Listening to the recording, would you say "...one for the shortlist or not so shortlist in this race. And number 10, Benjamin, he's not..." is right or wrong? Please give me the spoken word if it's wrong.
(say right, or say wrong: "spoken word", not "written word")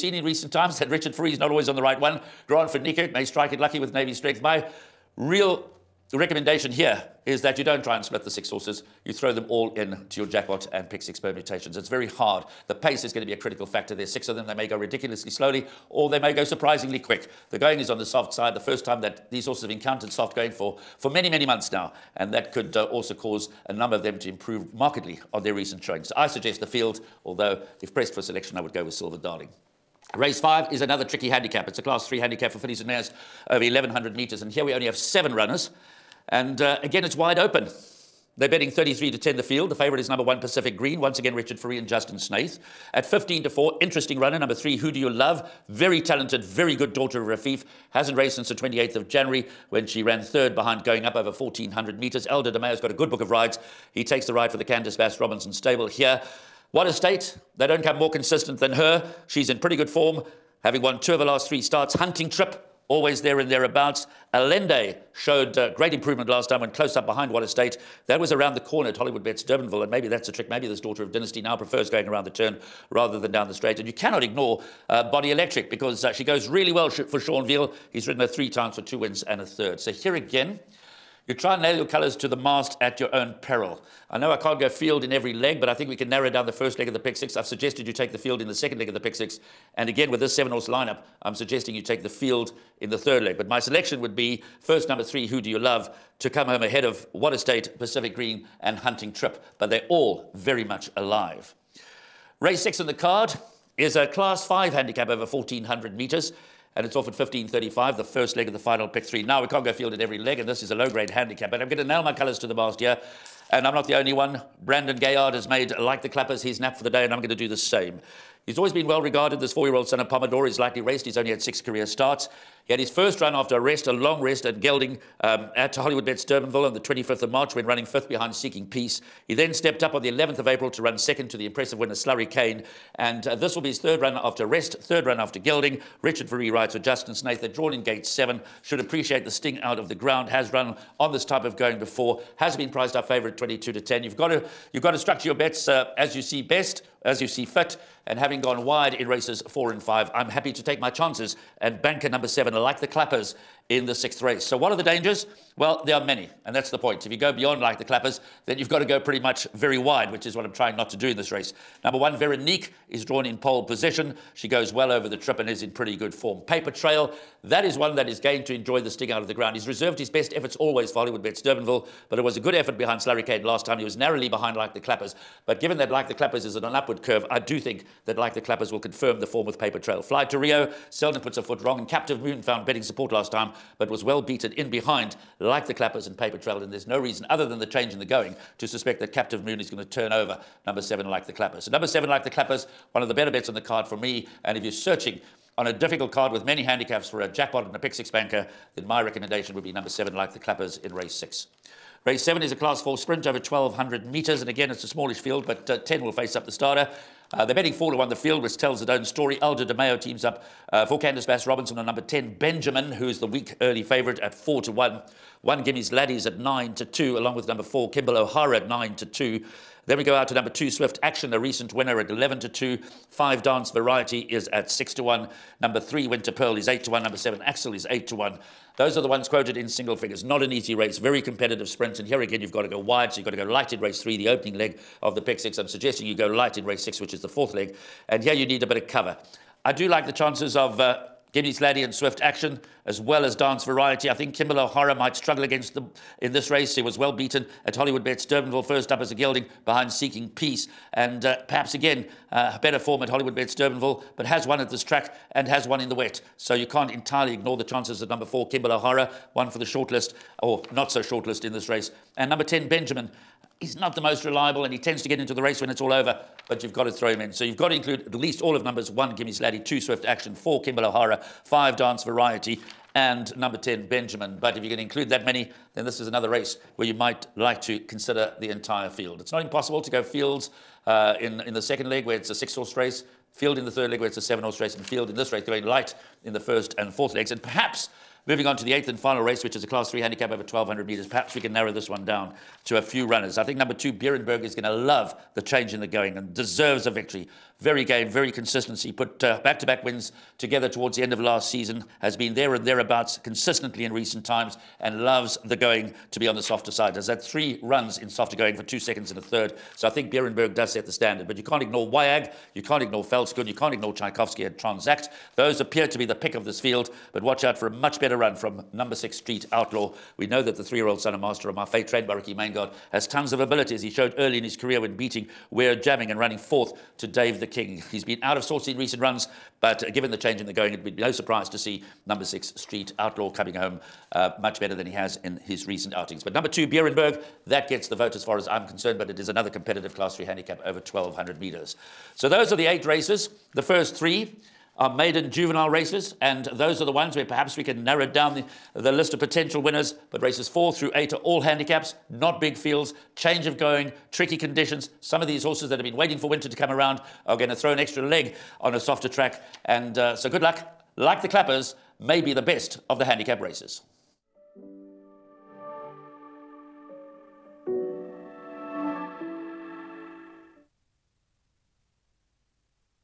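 right.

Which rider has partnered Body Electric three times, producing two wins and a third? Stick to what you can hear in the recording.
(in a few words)
Sean Veale.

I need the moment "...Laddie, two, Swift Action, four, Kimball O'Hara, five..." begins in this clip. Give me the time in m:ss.
4:29.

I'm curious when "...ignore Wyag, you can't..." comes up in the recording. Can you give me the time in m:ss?
5:11.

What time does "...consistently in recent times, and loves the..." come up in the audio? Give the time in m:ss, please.
5:03.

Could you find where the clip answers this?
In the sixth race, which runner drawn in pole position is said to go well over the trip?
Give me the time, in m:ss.
2:42.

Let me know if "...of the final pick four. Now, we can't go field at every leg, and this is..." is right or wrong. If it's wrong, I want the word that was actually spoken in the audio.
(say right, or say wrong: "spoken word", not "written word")
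wrong: "three", not "four".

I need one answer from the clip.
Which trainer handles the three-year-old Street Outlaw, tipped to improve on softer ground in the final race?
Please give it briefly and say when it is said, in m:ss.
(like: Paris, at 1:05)
Ricky Mangard, at 5:22.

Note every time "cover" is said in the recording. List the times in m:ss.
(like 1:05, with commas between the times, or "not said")
3:58.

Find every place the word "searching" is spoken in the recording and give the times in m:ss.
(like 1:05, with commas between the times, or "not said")
3:14.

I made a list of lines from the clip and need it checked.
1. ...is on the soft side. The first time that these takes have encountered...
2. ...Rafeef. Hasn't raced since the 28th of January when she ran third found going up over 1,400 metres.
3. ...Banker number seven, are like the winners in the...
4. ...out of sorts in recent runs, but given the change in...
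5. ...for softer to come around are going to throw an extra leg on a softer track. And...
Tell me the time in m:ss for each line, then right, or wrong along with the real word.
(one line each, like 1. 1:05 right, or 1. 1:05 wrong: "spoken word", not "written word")
1. 0:17 wrong: "horses", not "takes"
2. 0:47 wrong: "behind", not "found"
3. 2:31 wrong: "clappers", not "winners"
4. 5:28 right
5. 5:56 wrong: "winter", not "softer".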